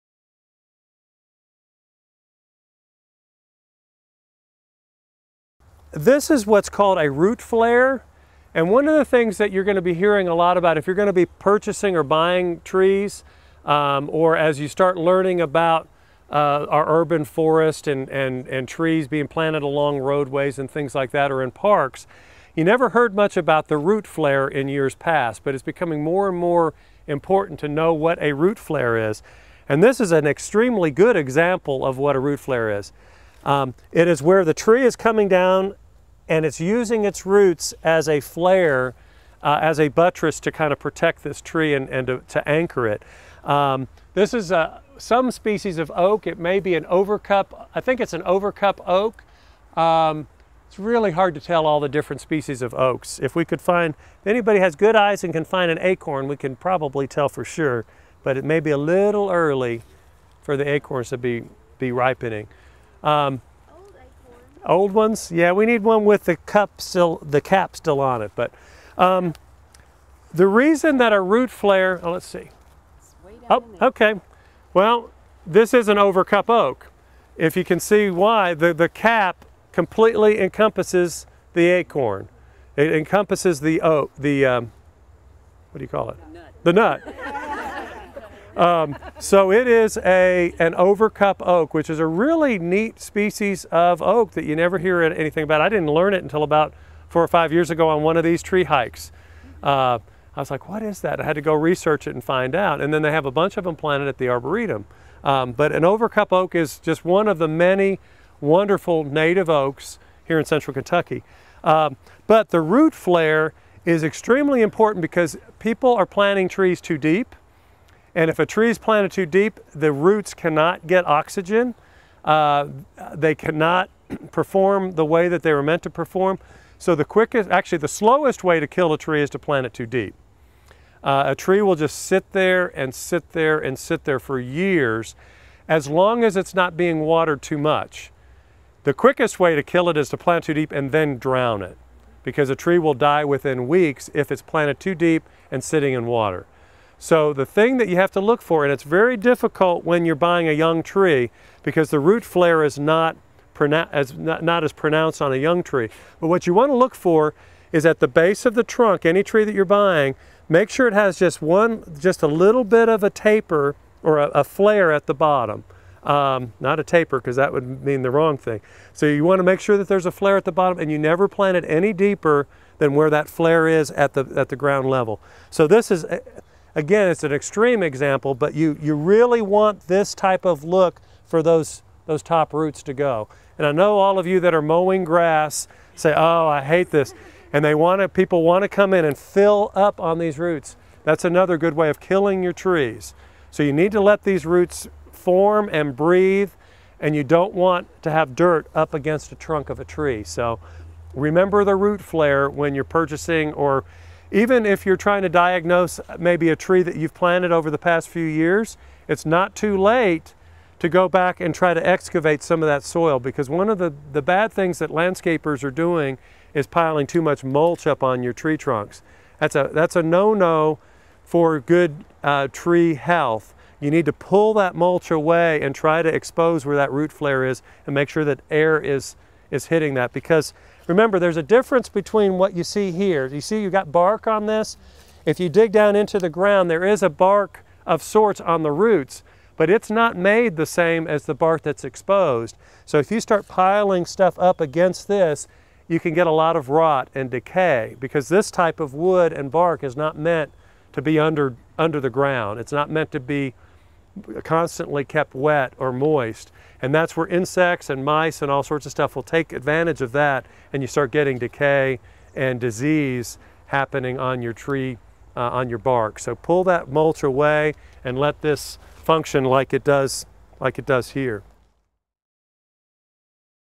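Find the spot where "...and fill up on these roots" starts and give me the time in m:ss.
3:09.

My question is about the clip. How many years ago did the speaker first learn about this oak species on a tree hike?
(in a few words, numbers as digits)
4 or 5.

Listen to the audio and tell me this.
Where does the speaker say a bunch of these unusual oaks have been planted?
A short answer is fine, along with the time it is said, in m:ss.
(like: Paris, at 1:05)
The Arboretum, at 1:44.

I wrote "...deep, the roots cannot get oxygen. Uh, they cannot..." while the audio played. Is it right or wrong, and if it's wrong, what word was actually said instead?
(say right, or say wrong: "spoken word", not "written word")
right.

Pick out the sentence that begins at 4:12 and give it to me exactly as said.
It's not meant to be constantly kept wet or moist.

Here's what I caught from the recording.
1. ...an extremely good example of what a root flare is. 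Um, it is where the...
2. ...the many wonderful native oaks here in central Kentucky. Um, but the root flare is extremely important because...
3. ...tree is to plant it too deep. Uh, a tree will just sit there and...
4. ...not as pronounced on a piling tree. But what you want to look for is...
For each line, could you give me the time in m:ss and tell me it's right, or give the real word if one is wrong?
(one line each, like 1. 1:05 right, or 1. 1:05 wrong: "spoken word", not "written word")
1. 0:30 right
2. 1:47 right
3. 2:08 right
4. 2:34 wrong: "young", not "piling".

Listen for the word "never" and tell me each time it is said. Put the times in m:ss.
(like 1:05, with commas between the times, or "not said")
0:22, 1:34, 2:50.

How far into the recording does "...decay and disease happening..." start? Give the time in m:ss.
4:21.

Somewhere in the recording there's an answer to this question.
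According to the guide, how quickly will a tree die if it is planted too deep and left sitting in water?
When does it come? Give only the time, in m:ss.
2:23.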